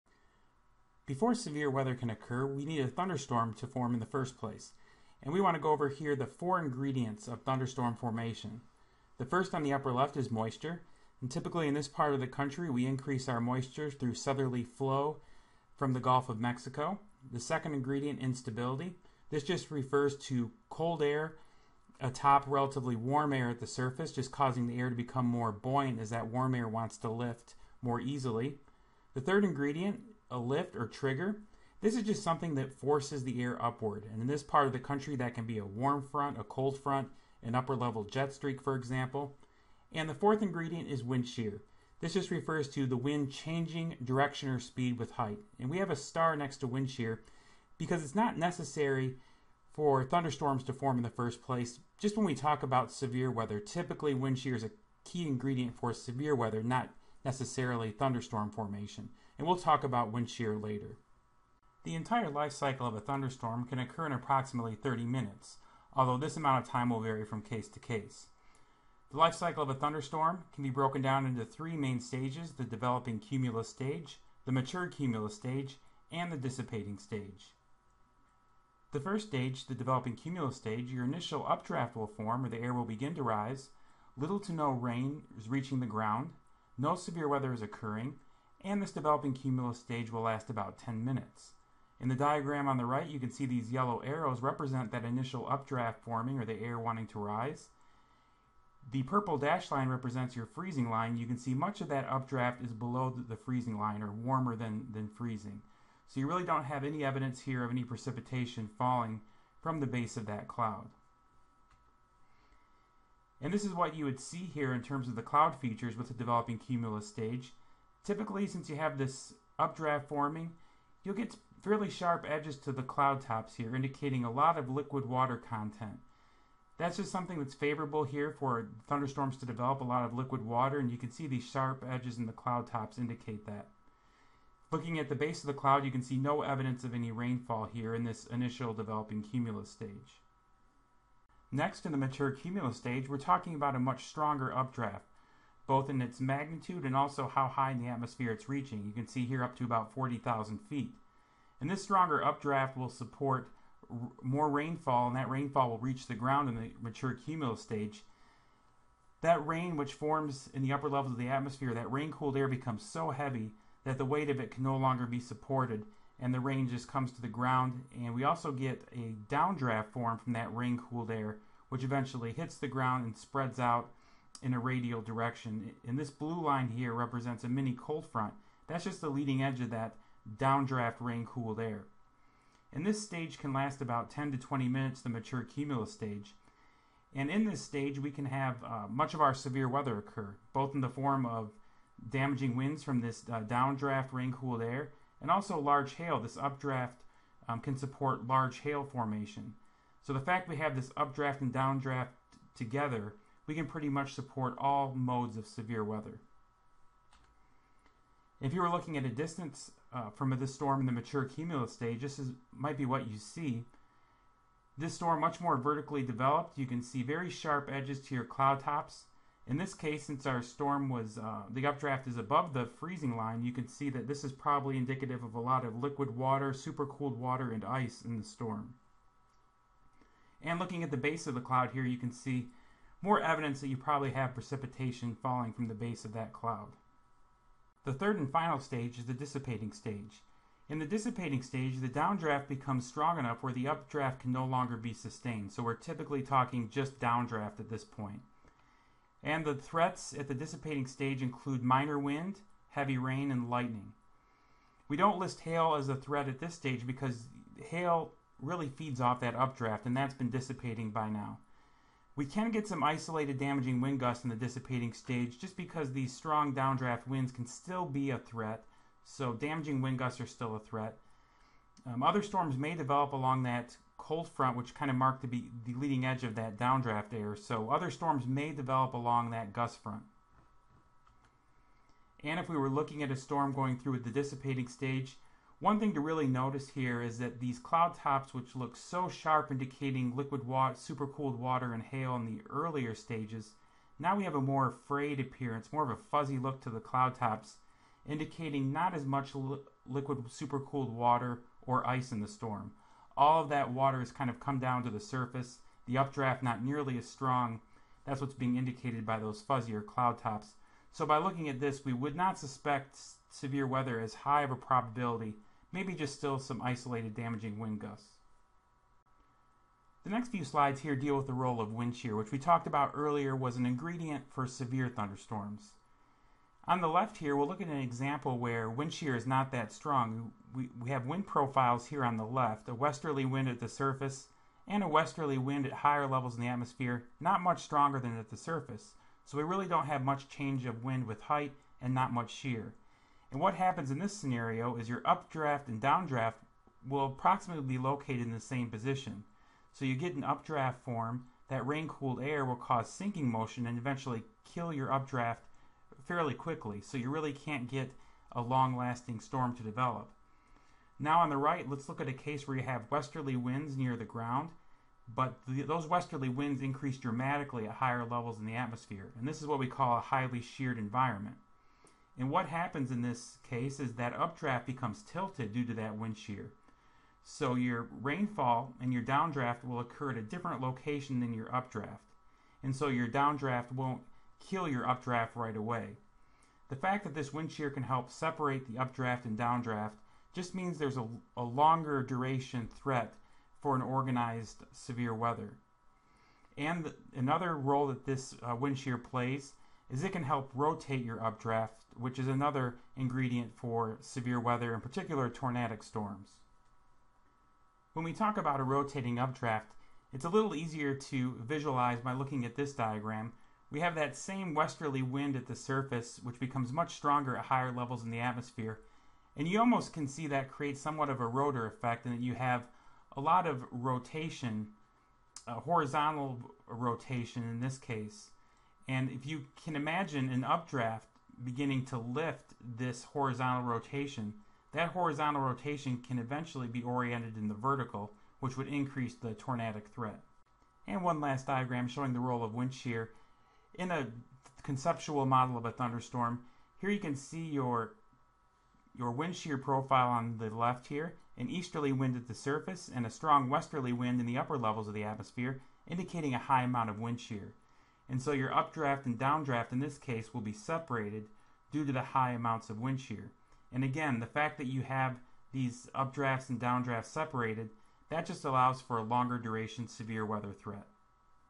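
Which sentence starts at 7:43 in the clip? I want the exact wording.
And again, the fact that you have these updrafts and downdrafts separated, that just allows for a longer duration severe weather threat.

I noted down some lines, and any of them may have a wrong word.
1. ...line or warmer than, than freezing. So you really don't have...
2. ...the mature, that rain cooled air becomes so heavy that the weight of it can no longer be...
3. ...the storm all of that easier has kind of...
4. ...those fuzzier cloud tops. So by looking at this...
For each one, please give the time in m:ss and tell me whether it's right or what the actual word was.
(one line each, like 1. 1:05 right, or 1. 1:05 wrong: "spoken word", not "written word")
1. 1:43 right
2. 2:41 wrong: "atmosphere", not "mature"
3. 5:02 wrong: "water", not "easier"
4. 5:09 right.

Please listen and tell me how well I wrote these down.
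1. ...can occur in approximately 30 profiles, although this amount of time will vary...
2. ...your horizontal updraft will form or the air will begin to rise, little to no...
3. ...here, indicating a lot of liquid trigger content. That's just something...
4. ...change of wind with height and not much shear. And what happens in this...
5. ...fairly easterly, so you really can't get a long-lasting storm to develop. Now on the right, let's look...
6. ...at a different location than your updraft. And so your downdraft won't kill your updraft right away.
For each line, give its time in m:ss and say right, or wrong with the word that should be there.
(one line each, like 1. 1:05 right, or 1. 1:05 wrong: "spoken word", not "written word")
1. 1:03 wrong: "minutes", not "profiles"
2. 1:20 wrong: "initial", not "horizontal"
3. 2:03 wrong: "water", not "trigger"
4. 5:40 right
5. 5:56 wrong: "quickly", not "easterly"
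6. 6:20 right.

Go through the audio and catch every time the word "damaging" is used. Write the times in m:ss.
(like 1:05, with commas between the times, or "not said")
3:12, 4:23, 4:29, 5:17.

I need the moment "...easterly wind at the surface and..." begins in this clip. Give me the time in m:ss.
7:31.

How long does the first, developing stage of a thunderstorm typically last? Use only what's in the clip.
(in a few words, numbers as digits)
10 minutes.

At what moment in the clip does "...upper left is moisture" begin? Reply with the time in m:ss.
0:09.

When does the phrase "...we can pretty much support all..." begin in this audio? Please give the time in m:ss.
3:23.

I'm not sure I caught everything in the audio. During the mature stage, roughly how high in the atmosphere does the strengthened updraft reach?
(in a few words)
40,000 feet.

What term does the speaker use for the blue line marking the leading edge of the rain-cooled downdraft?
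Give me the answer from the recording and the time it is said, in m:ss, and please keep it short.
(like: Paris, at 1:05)
mini cold front, at 2:57.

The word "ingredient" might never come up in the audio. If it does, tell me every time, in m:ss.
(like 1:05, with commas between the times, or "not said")
0:06, 0:17, 0:29, 0:40, 0:55, 5:23, 6:42.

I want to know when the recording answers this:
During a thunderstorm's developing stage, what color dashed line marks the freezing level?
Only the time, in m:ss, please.
1:39.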